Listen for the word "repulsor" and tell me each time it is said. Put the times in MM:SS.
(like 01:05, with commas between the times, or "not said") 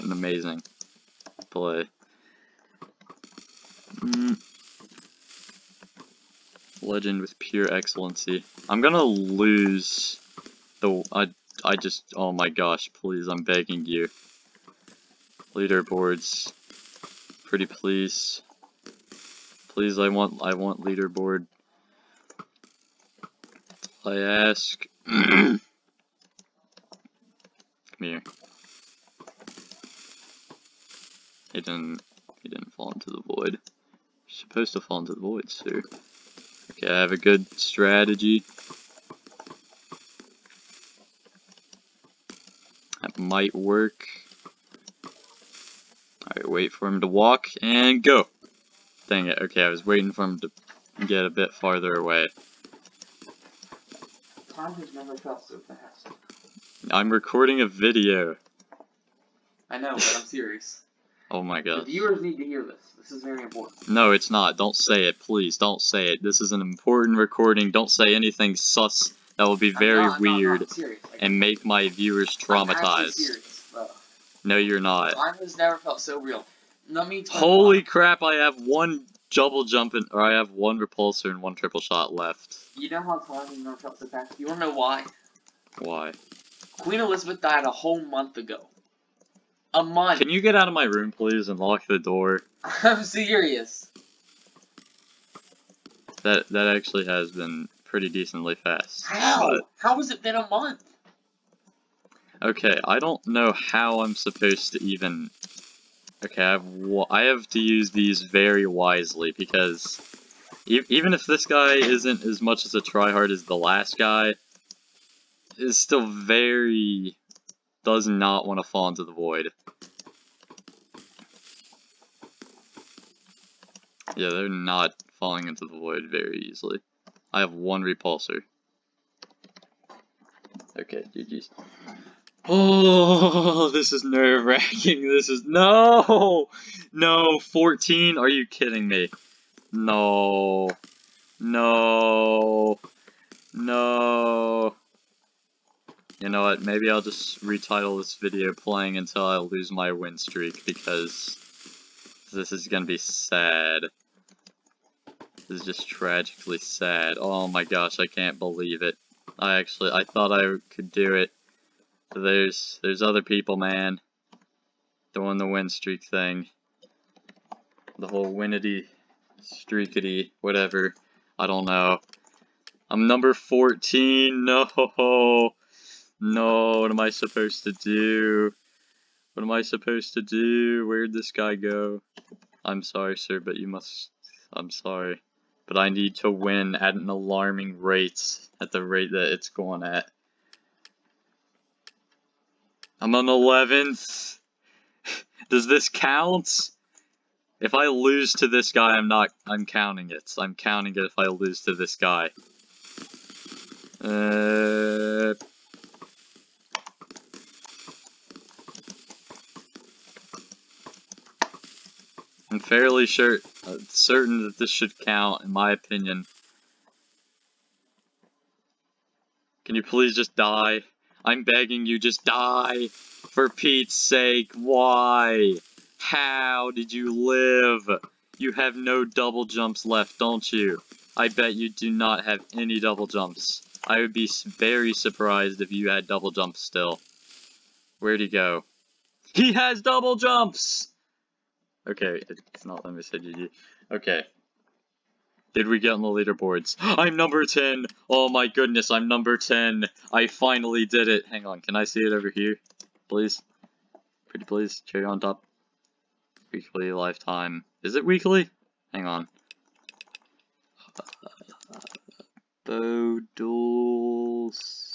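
01:20, 02:07.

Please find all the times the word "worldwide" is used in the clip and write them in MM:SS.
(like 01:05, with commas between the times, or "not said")
not said.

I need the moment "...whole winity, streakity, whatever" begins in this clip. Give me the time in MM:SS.
02:48.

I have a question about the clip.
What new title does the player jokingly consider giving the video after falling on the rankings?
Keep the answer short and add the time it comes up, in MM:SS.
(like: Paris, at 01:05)
playing until I lose my win streak, at 02:28.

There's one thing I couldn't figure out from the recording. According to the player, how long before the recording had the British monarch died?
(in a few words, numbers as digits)
a whole month.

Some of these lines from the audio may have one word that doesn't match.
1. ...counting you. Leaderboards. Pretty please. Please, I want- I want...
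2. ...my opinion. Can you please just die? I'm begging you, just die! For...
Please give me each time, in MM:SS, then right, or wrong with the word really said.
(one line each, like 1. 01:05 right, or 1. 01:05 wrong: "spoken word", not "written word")
1. 00:13 wrong: "begging", not "counting"
2. 03:35 right.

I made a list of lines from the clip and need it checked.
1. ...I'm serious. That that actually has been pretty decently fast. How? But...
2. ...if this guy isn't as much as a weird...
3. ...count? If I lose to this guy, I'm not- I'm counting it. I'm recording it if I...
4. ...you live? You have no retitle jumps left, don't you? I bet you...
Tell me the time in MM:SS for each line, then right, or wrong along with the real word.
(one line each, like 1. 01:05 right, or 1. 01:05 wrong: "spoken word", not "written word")
1. 01:32 right
2. 01:51 wrong: "tryhard", not "weird"
3. 03:15 wrong: "counting", not "recording"
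4. 03:46 wrong: "double", not "retitle".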